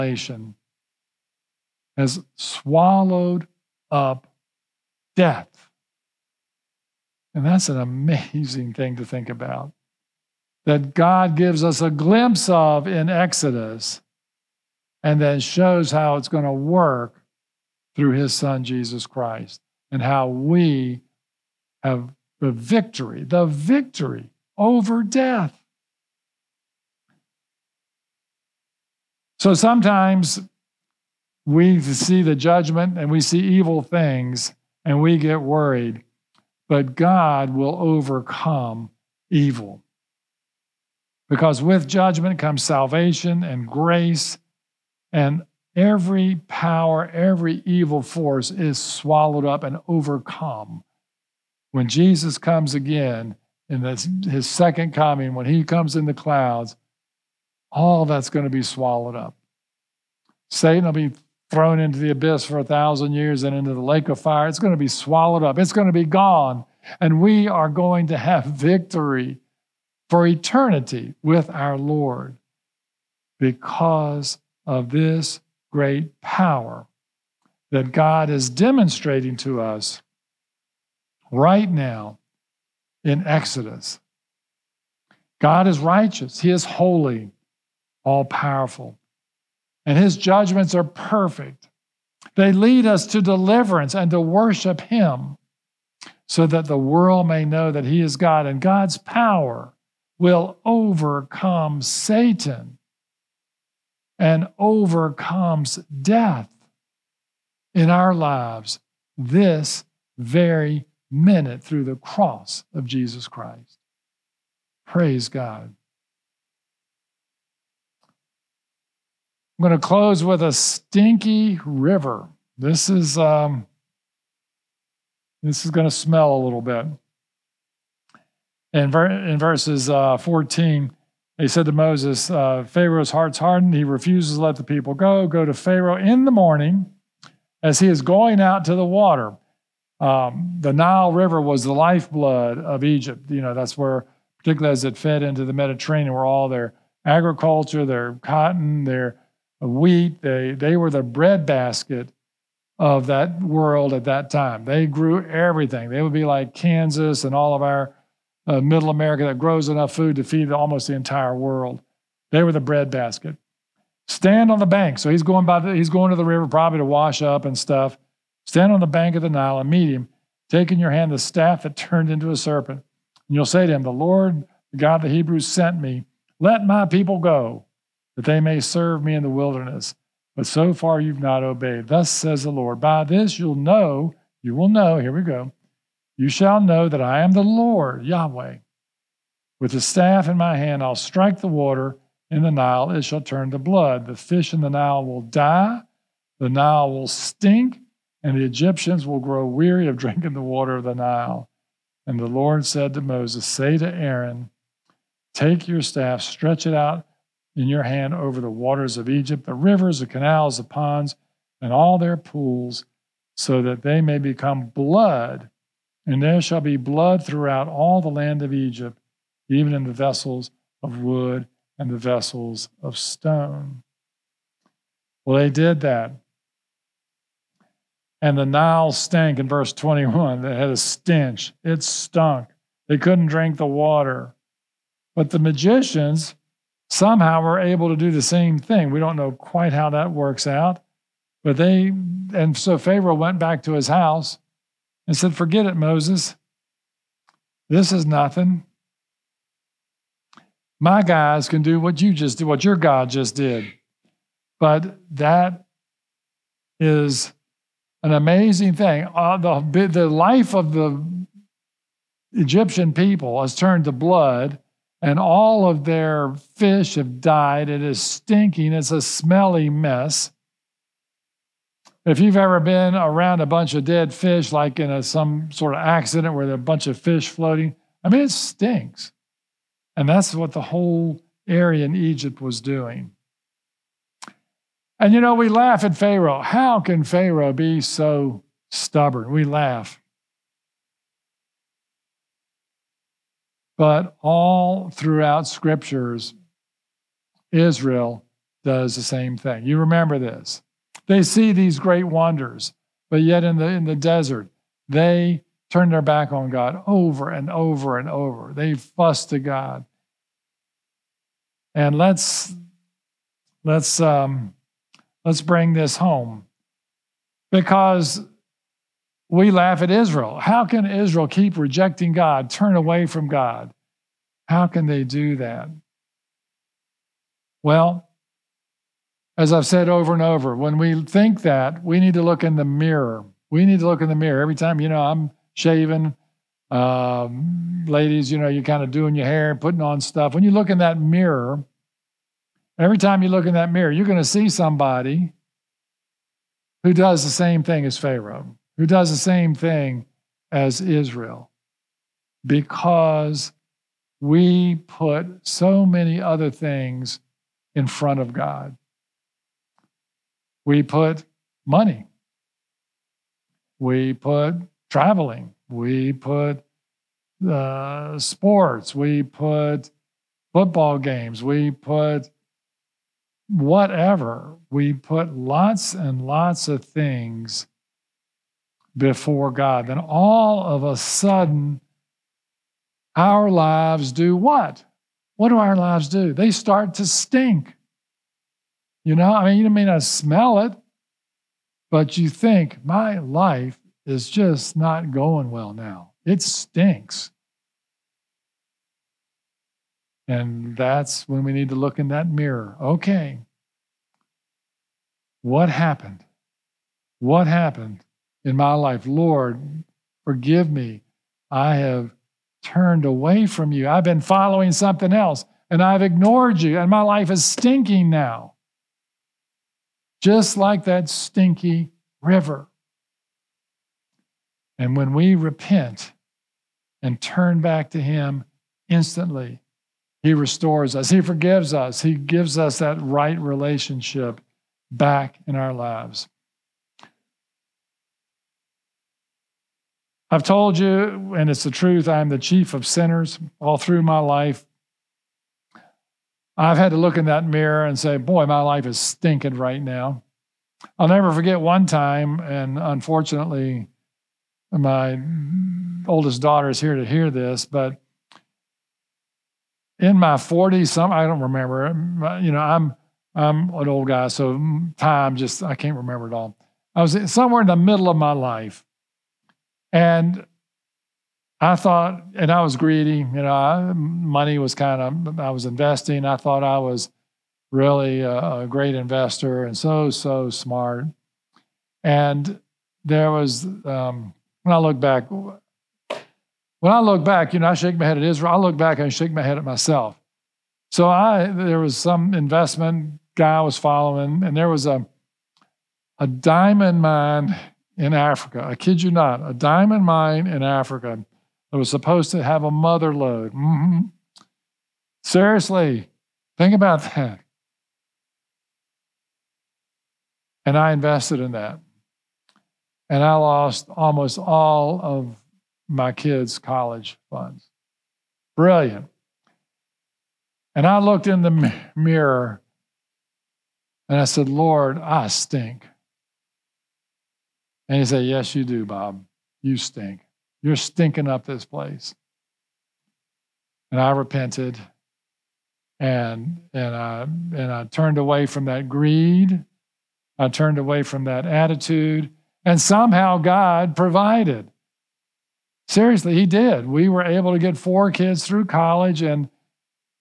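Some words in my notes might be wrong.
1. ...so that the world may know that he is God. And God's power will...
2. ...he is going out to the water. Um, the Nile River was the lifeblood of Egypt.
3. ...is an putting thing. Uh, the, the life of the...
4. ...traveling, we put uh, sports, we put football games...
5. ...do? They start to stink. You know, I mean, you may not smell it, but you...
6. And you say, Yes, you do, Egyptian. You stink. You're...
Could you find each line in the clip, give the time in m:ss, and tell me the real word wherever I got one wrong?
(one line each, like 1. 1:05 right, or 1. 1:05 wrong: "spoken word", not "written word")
1. 1:36 right
2. 2:17 right
3. 4:16 wrong: "amazing", not "putting"
4. 6:04 right
5. 6:26 right
6. 8:47 wrong: "Bob", not "Egyptian".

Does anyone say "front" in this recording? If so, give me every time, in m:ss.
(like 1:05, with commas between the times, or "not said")
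5:57.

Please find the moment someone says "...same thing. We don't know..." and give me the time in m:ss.
3:58.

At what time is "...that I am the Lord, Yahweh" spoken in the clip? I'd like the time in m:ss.
3:06.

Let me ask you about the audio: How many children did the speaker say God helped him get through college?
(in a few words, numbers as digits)
4.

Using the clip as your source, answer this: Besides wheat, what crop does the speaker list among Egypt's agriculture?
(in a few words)
Cotton.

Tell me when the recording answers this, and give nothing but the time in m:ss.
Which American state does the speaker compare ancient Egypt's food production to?
2:36.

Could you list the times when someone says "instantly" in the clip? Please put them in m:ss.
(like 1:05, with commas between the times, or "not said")
7:08.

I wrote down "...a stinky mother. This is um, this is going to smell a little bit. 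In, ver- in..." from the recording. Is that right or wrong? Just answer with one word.
wrong.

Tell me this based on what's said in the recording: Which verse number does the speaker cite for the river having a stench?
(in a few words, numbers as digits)
21.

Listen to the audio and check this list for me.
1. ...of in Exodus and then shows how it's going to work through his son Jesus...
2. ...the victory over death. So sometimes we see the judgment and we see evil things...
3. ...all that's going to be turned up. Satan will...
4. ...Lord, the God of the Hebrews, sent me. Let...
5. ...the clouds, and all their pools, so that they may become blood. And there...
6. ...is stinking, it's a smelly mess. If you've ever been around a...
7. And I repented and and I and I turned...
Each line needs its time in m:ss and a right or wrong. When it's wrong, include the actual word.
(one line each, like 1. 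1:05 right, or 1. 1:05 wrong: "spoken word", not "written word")
1. 0:12 right
2. 0:23 right
3. 0:57 wrong: "swallowed", not "turned"
4. 2:53 right
5. 3:30 wrong: "ponds", not "clouds"
6. 4:27 right
7. 8:53 right.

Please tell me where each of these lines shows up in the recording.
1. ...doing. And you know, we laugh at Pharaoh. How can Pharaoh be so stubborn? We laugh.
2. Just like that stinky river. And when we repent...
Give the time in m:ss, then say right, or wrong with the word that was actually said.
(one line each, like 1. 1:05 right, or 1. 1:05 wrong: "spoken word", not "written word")
1. 4:42 right
2. 7:00 right.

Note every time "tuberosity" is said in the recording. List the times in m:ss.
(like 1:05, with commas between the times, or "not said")
not said.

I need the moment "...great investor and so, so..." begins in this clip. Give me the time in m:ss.
7:58.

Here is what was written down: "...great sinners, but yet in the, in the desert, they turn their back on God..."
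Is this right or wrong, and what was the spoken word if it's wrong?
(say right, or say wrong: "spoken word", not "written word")
wrong: "wonders", not "sinners".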